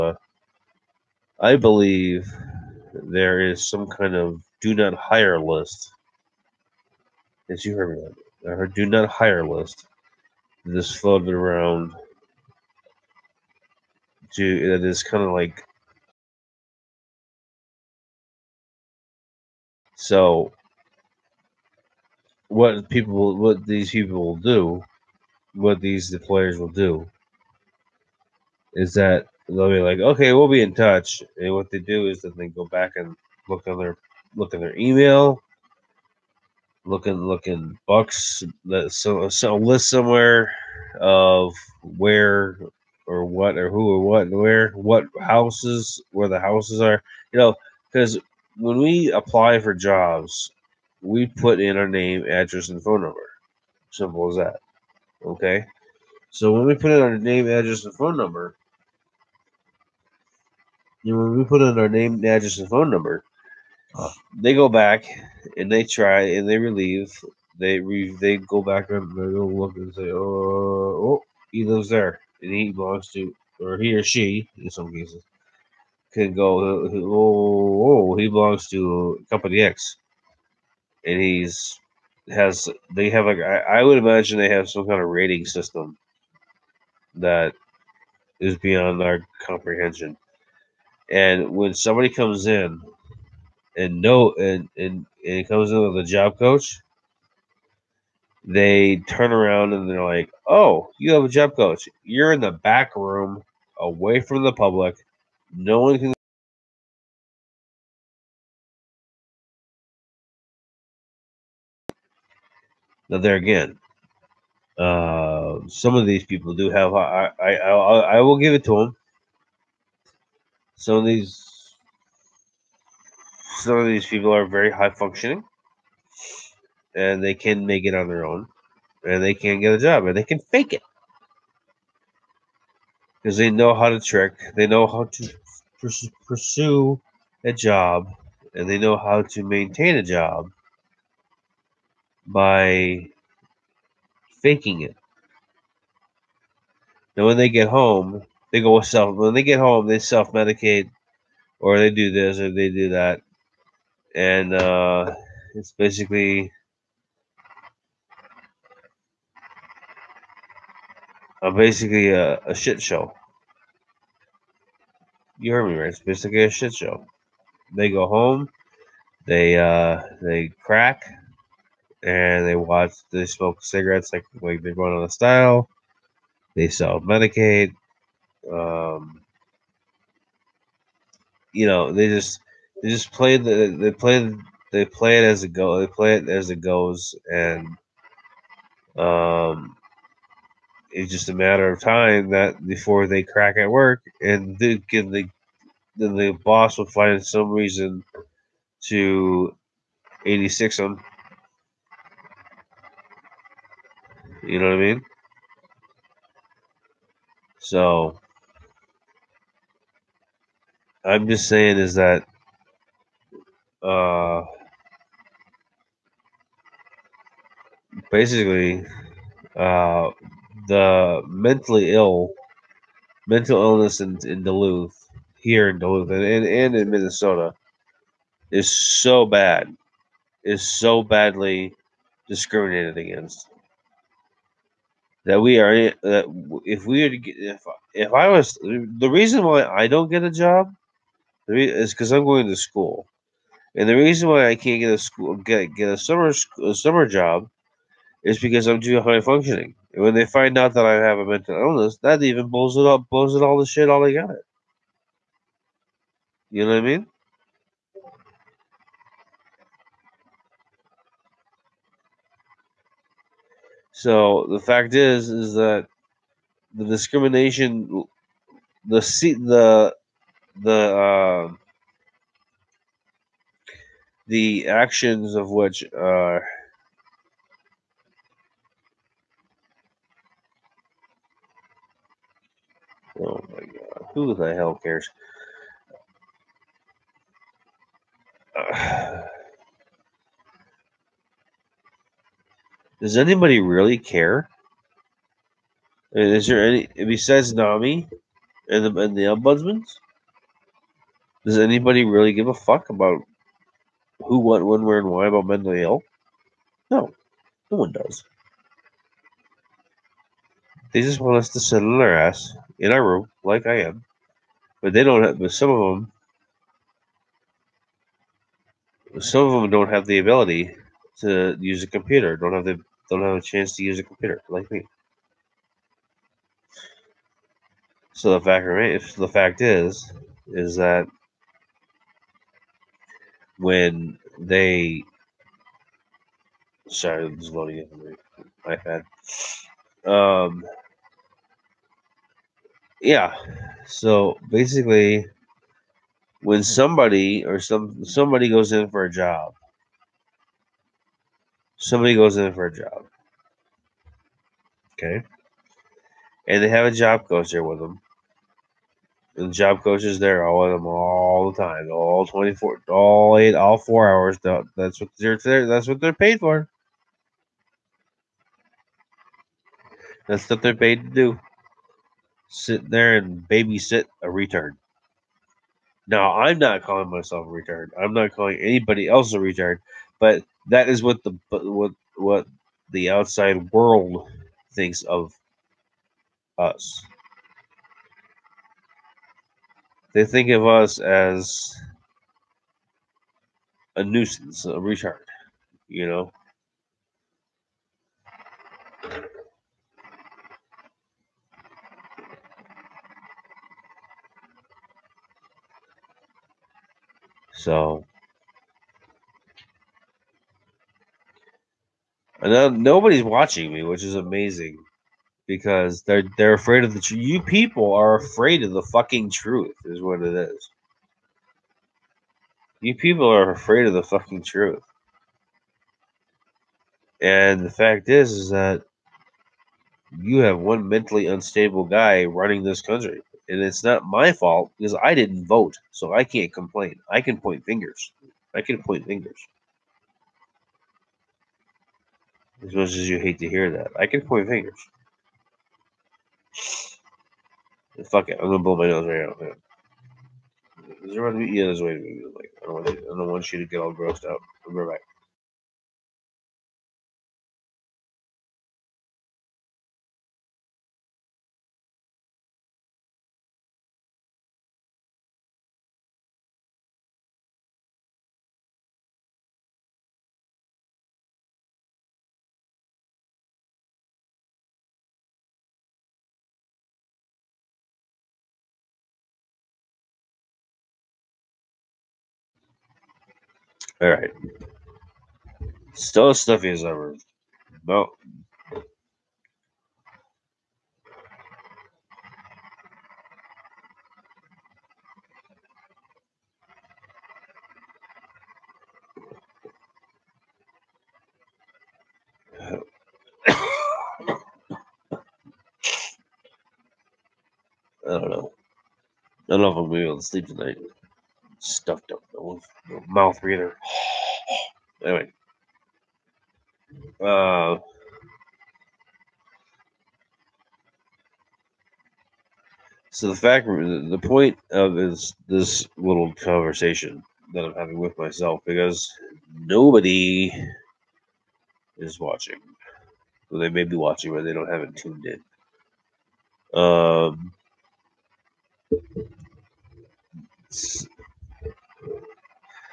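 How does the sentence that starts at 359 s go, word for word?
And the job coach is there all with them all the time, all twenty four, all eight, all four hours.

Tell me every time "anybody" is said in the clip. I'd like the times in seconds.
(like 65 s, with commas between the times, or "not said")
293 s, 301 s, 378 s.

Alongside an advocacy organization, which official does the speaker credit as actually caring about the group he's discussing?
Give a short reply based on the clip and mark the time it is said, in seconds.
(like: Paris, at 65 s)
the ombudsman, at 299 s.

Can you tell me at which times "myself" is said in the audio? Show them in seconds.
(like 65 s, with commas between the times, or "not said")
377 s, 528 s.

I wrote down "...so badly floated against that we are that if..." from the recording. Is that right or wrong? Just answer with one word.
wrong.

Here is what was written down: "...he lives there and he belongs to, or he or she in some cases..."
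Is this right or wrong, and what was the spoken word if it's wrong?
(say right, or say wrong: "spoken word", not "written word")
right.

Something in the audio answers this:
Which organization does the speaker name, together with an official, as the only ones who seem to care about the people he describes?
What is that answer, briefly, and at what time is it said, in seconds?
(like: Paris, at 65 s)
NAMI, at 297 s.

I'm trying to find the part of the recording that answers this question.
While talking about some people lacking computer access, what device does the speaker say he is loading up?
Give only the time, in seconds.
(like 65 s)
338 s.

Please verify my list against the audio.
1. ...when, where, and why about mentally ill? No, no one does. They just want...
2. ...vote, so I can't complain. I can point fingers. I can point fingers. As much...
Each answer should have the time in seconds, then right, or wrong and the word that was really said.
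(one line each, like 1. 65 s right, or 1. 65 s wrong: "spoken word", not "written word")
1. 304 s right
2. 435 s right.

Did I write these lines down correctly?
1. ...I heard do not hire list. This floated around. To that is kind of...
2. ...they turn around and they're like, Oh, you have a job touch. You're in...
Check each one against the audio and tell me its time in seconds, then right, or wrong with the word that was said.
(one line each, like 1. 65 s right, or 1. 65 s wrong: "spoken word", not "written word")
1. 8 s right
2. 98 s wrong: "coach", not "touch".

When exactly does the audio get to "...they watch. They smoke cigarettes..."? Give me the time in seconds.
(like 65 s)
172 s.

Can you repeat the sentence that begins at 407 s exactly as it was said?
So and nobody's watching me, which is amazing because they're they're afraid of the truth.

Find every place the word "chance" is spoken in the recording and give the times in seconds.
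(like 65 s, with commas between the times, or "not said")
323 s.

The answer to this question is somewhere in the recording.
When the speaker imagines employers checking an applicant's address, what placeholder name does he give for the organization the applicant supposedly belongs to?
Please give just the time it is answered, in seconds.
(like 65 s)
79 s.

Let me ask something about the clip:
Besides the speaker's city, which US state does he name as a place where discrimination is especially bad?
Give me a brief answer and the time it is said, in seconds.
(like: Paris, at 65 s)
Minnesota, at 226 s.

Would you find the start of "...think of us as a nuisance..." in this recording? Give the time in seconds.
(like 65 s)
390 s.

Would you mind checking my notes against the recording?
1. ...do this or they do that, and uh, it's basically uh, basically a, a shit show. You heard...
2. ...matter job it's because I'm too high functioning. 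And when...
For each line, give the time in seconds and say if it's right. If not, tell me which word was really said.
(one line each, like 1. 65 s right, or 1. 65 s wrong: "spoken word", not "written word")
1. 151 s right
2. 246 s wrong: "summer", not "matter".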